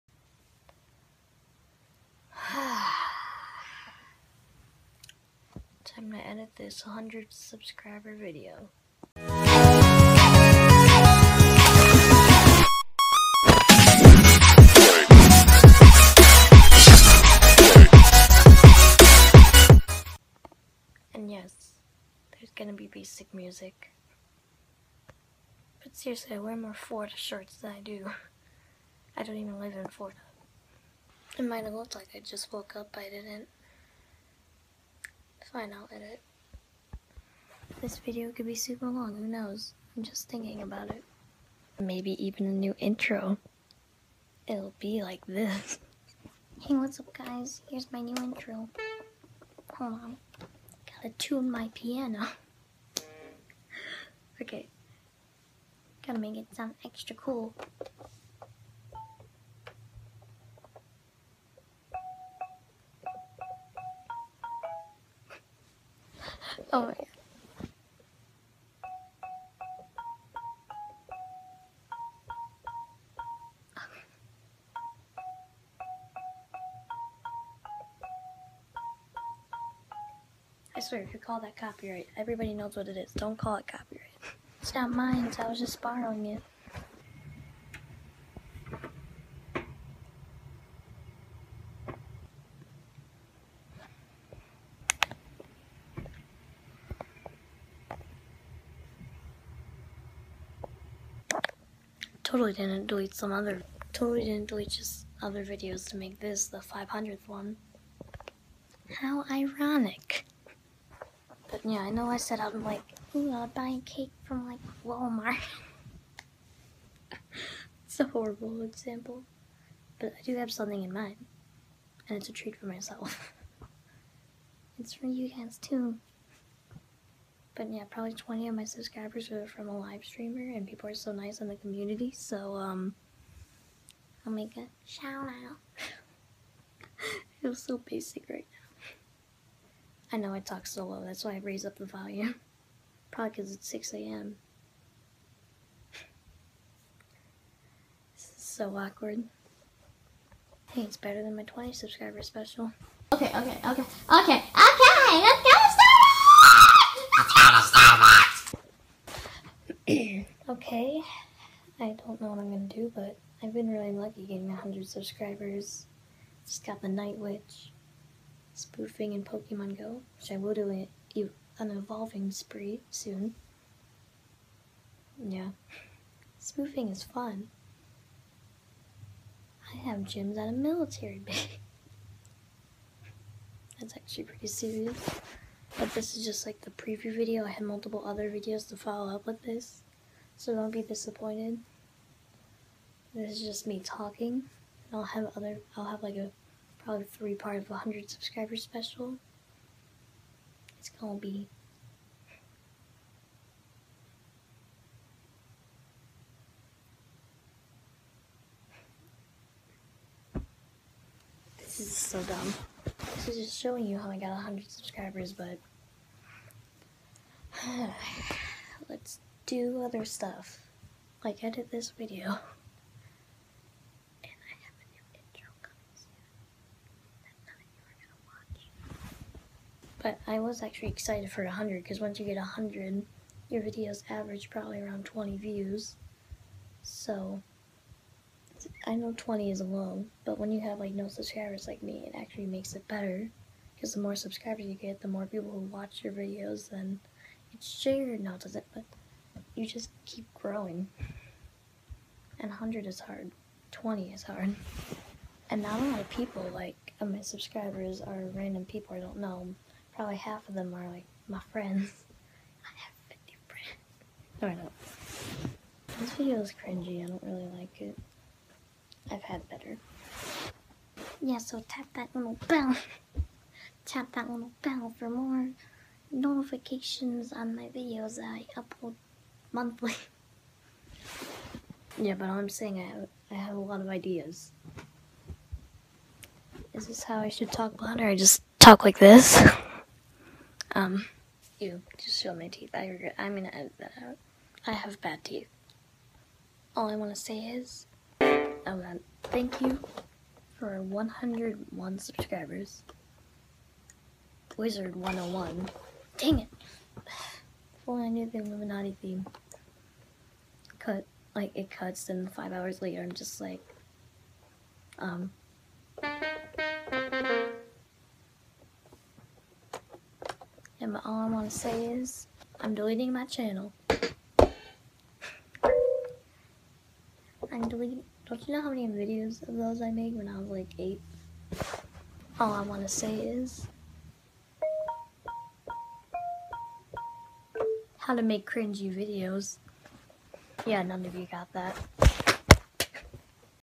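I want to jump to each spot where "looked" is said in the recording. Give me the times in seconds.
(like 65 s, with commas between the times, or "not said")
31 s.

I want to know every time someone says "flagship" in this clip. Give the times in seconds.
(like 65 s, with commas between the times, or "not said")
not said.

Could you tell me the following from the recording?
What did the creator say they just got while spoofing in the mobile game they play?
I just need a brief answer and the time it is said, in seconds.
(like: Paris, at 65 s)
Night Witch, at 166 s.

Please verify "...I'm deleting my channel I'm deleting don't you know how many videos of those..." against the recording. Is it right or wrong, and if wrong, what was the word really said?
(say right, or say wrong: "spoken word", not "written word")
right.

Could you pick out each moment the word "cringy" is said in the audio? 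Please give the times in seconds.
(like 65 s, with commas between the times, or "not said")
266 s, 338 s.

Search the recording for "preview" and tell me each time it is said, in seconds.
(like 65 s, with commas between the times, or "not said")
186 s.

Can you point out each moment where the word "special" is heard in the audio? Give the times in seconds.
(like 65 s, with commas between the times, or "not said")
152 s, 198 s.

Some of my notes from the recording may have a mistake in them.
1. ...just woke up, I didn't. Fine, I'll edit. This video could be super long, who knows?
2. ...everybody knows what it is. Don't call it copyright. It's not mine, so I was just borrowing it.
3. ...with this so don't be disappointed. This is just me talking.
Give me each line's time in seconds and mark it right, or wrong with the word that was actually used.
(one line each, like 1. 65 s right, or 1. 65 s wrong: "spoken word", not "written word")
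1. 32 s right
2. 82 s right
3. 189 s right.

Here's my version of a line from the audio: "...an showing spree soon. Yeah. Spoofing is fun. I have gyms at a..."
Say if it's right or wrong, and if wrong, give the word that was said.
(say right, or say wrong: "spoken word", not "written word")
wrong: "evolving", not "showing".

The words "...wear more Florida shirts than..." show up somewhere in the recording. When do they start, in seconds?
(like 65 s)
26 s.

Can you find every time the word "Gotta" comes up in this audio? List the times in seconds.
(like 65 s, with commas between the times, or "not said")
50 s, 56 s.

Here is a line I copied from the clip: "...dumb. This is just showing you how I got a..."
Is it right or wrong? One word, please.
right.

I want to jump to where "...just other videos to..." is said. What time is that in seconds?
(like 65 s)
104 s.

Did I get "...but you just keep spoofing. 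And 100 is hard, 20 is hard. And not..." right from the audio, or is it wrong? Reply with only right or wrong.
wrong.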